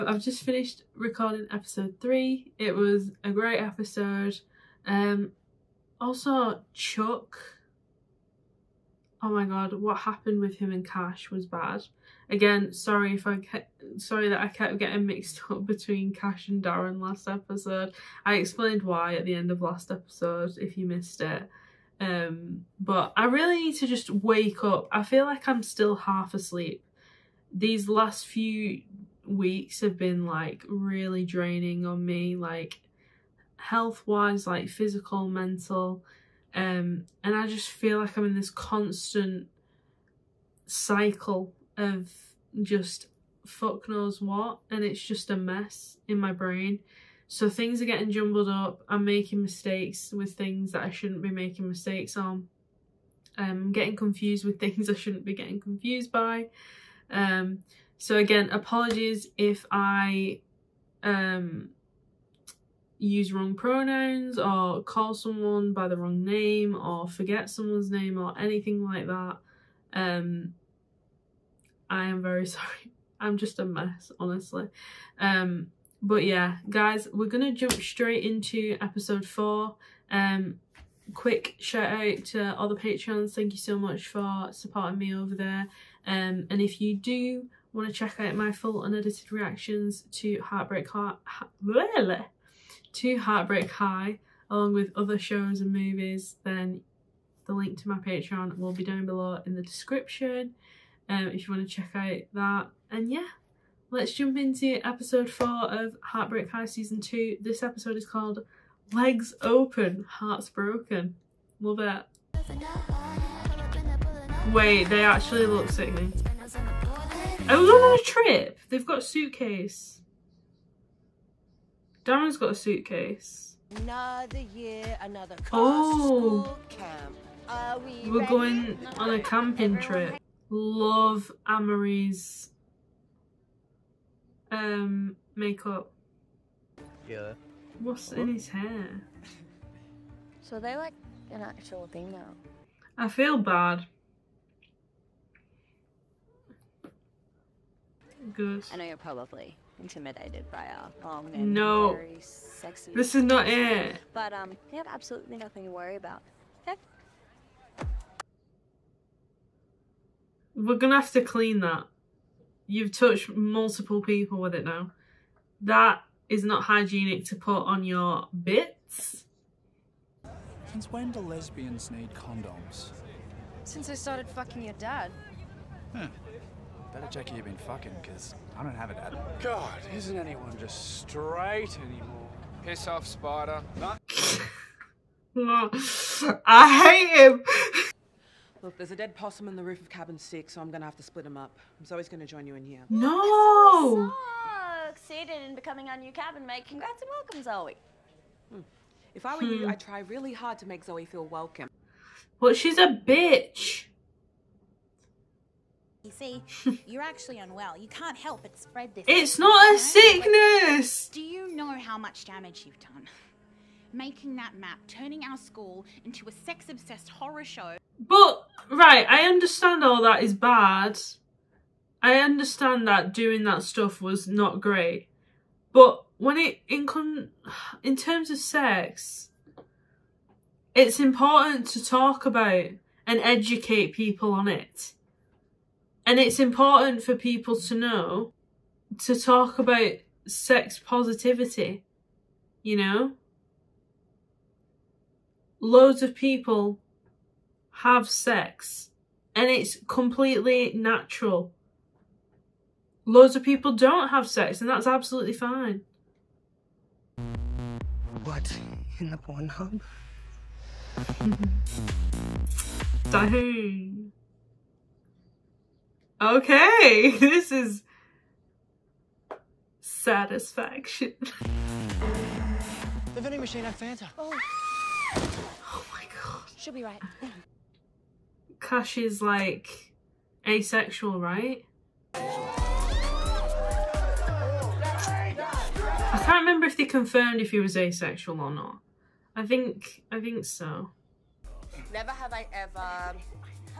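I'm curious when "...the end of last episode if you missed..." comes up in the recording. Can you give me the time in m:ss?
0:19.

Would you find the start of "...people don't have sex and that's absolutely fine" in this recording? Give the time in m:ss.
4:13.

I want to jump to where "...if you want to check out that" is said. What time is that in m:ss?
1:41.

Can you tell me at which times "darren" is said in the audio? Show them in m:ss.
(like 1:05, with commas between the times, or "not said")
0:16, 2:02.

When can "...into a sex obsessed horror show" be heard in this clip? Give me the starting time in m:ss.
3:36.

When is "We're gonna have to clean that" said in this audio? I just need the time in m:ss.
2:40.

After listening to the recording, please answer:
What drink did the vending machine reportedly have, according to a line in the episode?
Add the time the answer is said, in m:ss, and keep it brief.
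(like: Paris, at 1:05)
Fanta, at 4:33.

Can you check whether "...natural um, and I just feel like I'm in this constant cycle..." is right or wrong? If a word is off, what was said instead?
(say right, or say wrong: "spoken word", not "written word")
wrong: "mental", not "natural".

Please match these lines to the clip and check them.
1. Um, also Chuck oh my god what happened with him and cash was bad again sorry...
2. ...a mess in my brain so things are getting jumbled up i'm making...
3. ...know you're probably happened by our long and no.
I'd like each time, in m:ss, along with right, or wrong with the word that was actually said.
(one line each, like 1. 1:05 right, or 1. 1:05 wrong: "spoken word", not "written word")
1. 0:04 right
2. 0:45 right
3. 2:28 wrong: "intimidated", not "happened".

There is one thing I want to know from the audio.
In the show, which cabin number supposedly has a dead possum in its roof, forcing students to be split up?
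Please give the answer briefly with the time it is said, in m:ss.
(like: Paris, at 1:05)
6, at 3:09.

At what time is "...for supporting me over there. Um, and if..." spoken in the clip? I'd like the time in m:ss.
1:24.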